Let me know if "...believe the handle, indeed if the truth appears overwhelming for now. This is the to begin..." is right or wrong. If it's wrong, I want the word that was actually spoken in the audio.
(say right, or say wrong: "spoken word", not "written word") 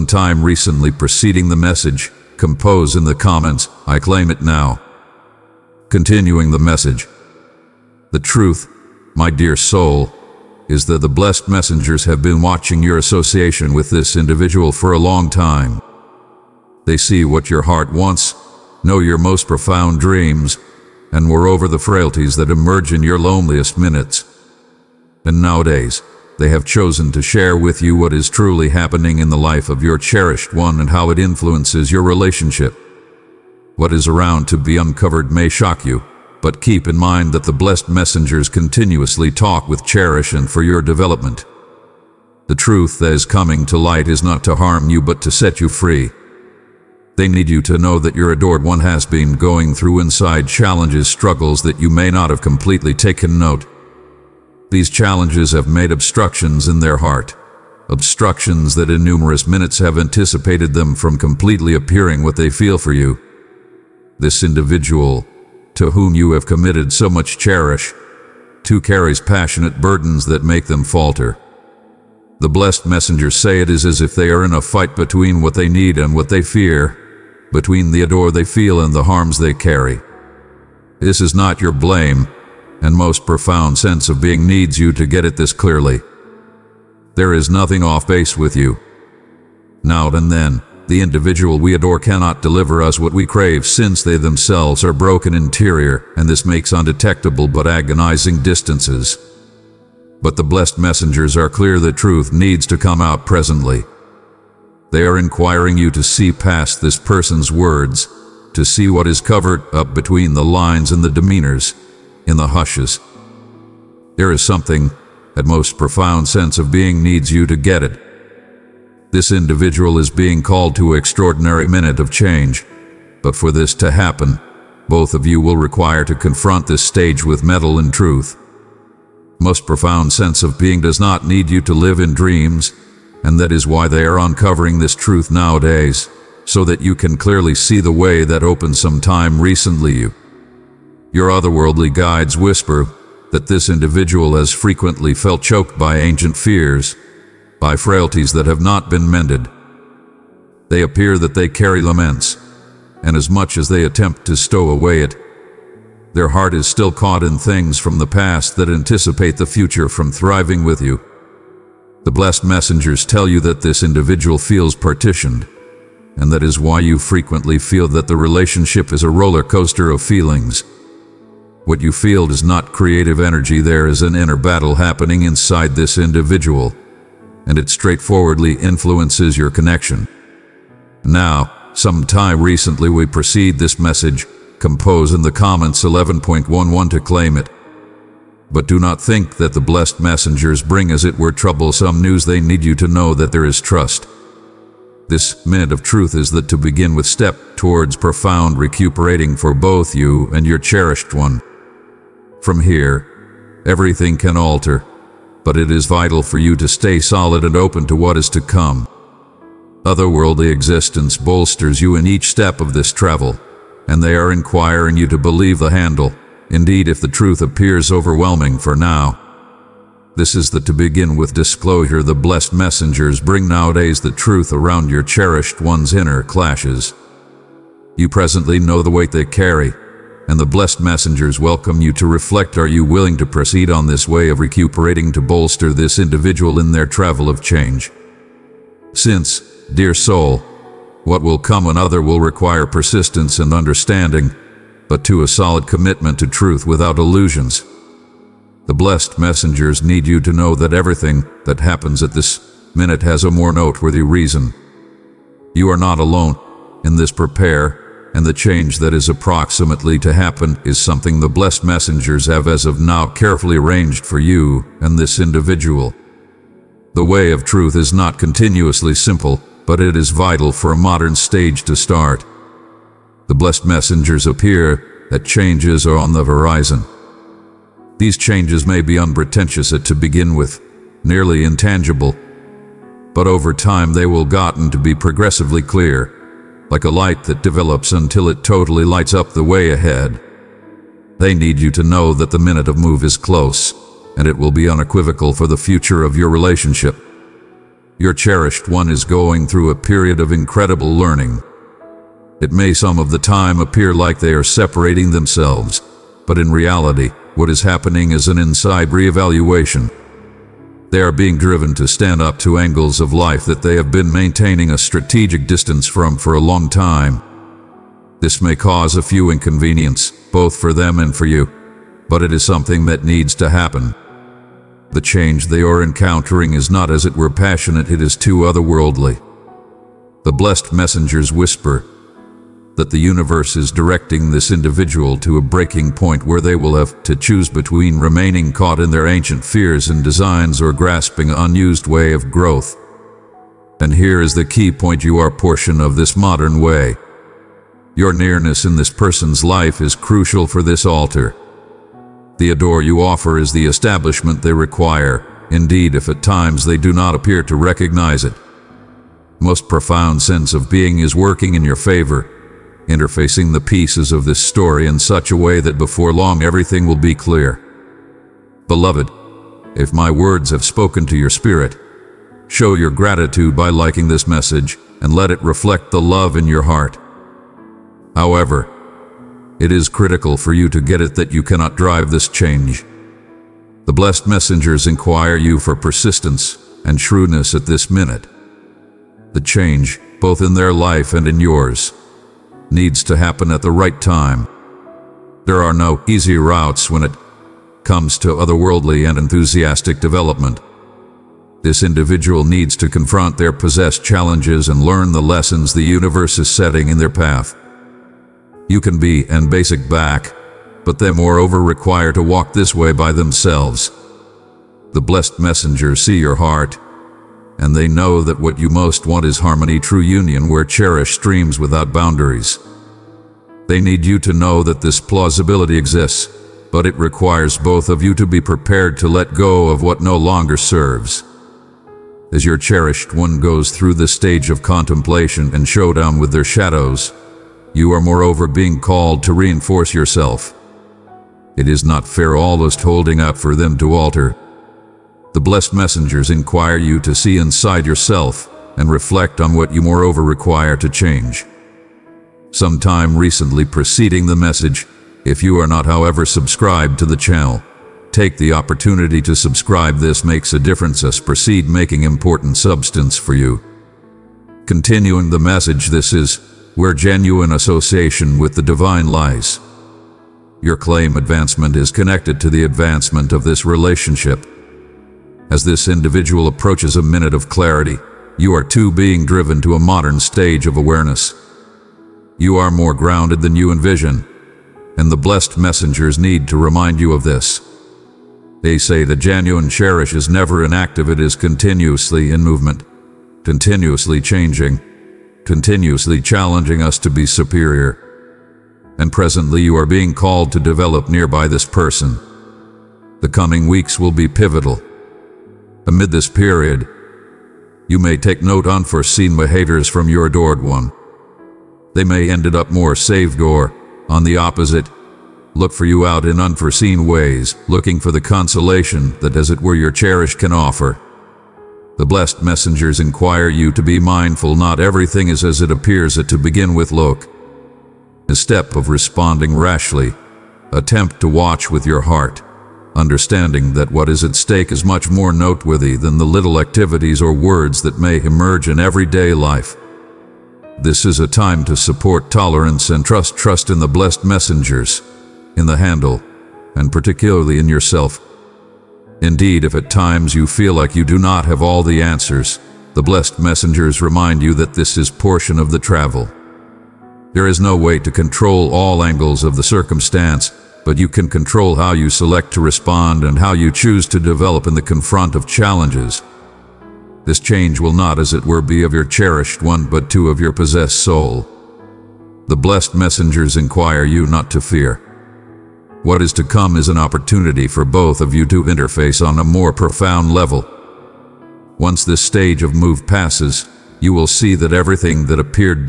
right.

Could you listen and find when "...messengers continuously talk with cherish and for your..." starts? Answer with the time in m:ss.
0:37.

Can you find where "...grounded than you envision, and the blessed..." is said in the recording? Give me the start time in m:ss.
8:02.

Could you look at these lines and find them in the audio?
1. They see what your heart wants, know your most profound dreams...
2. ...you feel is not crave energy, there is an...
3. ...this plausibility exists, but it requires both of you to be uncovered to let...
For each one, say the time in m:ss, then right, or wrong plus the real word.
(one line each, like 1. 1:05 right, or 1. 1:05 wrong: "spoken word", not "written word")
1. 0:16 right
2. 2:51 wrong: "creative", not "crave"
3. 7:04 wrong: "prepared", not "uncovered".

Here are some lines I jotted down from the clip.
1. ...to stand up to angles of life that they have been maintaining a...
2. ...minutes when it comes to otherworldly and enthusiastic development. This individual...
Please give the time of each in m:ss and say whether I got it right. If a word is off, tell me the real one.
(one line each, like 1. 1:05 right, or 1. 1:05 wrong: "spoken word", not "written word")
1. 5:11 right
2. 6:36 wrong: "routes", not "minutes".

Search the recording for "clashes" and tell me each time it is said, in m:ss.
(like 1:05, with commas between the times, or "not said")
3:46.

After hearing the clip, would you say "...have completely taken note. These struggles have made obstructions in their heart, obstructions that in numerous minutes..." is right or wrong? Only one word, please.
wrong.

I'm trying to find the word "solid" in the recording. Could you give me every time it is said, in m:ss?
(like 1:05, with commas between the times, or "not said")
3:26, 4:05.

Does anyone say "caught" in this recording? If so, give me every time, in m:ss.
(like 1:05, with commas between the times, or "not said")
2:36, 5:38.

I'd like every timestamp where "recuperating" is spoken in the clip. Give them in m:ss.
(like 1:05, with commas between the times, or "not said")
3:18, 3:54.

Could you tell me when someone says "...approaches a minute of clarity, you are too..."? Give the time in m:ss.
7:56.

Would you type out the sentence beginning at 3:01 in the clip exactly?
Now, some time recently we proceed this message, compose in the comments 11.11 to claim it.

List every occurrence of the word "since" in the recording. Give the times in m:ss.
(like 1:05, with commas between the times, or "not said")
1:33, 3:58.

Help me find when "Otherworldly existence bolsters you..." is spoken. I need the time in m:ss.
3:29.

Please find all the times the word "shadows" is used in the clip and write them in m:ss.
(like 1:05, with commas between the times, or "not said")
7:16.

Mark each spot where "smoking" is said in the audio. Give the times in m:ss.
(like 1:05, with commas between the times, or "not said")
not said.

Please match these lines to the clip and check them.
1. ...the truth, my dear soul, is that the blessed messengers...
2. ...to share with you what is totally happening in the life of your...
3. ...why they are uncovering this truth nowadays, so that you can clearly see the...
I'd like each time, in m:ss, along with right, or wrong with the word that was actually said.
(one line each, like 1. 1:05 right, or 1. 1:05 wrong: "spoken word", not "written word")
1. 0:08 right
2. 0:27 wrong: "truly", not "totally"
3. 2:13 right.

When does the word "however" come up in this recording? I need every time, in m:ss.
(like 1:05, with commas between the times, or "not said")
6:18, 7:35.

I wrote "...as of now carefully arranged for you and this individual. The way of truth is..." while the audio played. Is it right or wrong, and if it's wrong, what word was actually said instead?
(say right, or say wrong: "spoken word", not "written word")
right.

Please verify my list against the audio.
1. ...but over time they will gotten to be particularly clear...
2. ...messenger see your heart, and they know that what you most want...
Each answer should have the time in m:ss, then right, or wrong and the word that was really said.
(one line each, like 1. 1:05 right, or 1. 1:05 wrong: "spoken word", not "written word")
1. 4:43 wrong: "progressively", not "particularly"
2. 6:55 right.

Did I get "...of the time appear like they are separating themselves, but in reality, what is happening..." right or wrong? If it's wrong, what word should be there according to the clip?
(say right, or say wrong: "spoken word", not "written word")
right.